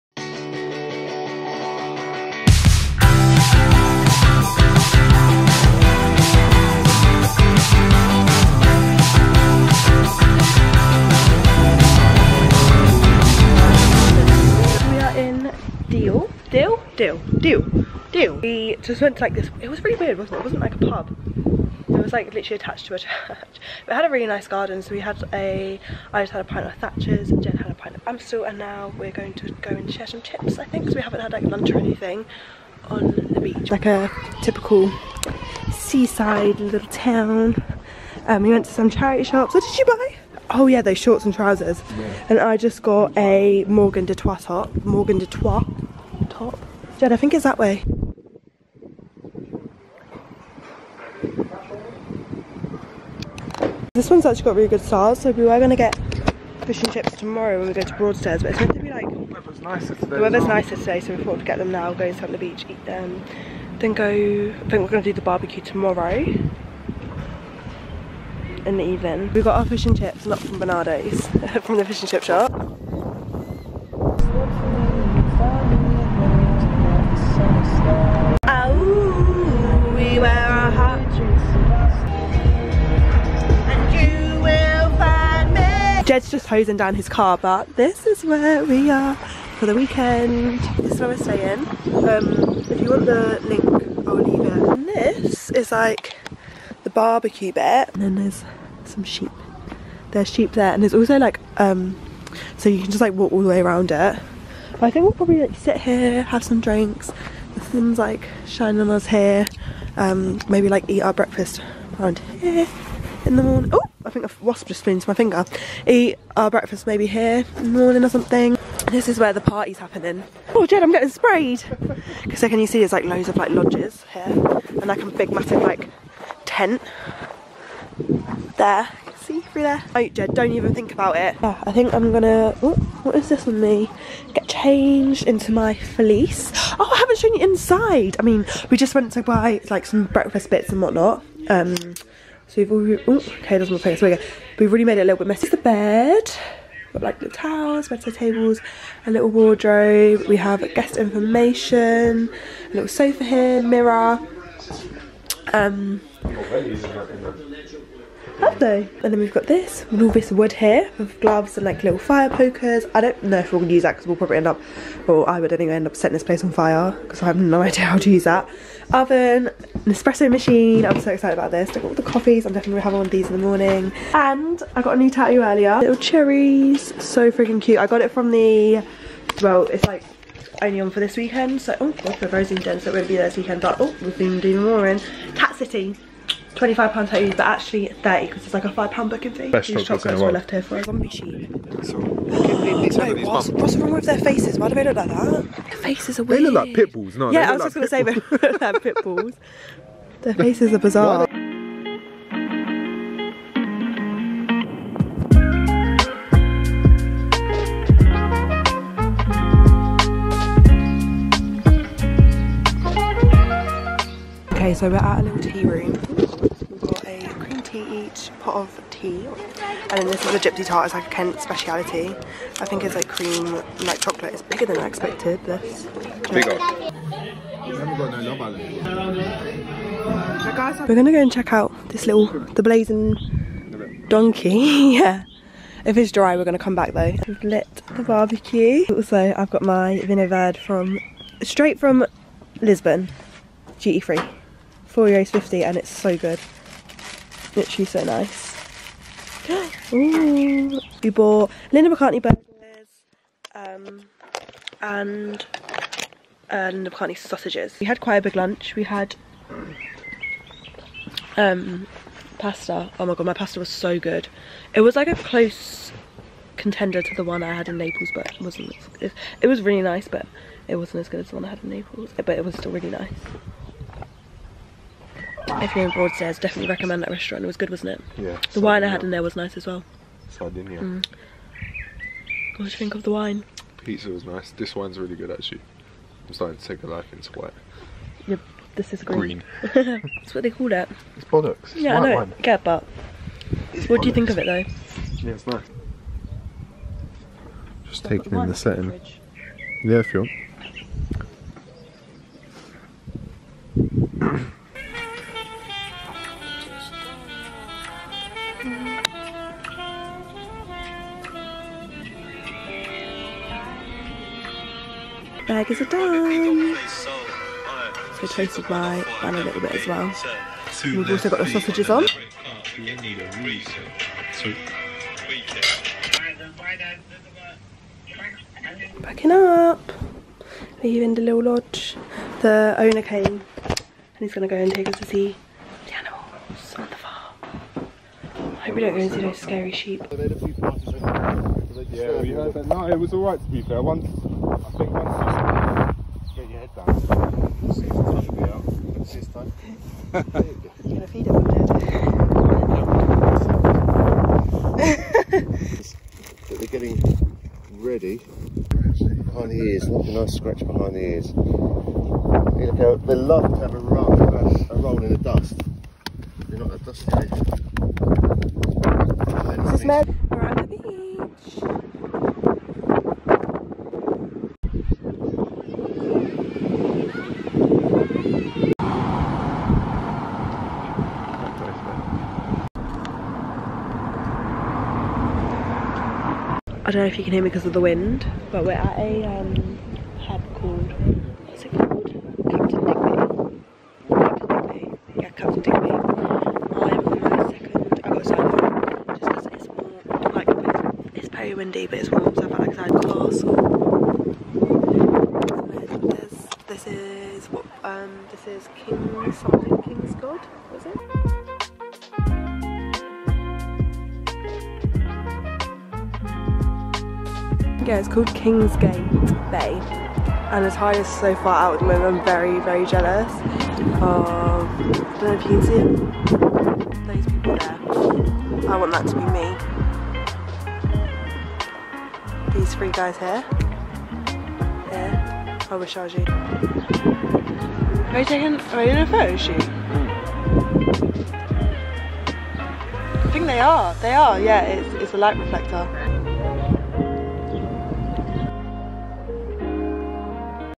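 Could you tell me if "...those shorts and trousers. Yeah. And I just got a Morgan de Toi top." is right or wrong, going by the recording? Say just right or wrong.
right.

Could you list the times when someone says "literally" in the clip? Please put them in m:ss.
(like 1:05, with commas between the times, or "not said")
0:22, 4:07.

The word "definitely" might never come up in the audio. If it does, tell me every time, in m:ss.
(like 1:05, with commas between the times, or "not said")
2:52, 4:36.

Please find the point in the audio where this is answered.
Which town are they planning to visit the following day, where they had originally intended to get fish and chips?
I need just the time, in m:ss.
0:57.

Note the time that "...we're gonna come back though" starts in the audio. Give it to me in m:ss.
3:56.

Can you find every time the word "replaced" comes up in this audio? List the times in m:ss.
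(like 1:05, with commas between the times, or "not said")
not said.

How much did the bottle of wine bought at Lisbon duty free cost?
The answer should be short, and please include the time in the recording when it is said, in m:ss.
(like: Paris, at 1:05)
4.50 euros, at 4:04.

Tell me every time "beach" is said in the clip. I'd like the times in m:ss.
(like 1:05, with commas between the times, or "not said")
0:33, 1:02.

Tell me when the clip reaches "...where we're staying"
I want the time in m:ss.
1:30.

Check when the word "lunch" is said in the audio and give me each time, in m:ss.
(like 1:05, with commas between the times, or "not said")
0:31, 4:18.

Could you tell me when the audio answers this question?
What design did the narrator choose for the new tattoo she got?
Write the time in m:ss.
2:55.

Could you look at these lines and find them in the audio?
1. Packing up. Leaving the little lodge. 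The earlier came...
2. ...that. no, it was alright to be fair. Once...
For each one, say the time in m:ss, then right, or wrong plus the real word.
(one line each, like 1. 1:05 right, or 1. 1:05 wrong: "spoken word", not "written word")
1. 5:29 wrong: "owner", not "earlier"
2. 5:42 right.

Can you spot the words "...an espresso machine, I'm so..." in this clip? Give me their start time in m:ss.
2:49.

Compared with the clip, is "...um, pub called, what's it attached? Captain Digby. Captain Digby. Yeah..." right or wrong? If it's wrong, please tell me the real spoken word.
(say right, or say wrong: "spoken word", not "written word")
wrong: "called", not "attached".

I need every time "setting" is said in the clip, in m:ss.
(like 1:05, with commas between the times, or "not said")
2:45, 4:58.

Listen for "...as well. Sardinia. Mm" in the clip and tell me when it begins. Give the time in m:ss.
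4:39.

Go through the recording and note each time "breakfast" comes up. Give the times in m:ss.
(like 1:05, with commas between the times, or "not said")
1:51, 1:56, 2:20.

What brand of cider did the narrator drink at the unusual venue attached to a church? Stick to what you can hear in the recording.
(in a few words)
Thatcher's.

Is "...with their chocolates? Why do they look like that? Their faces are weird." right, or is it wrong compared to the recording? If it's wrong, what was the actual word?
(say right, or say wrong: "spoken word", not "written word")
wrong: "faces", not "chocolates".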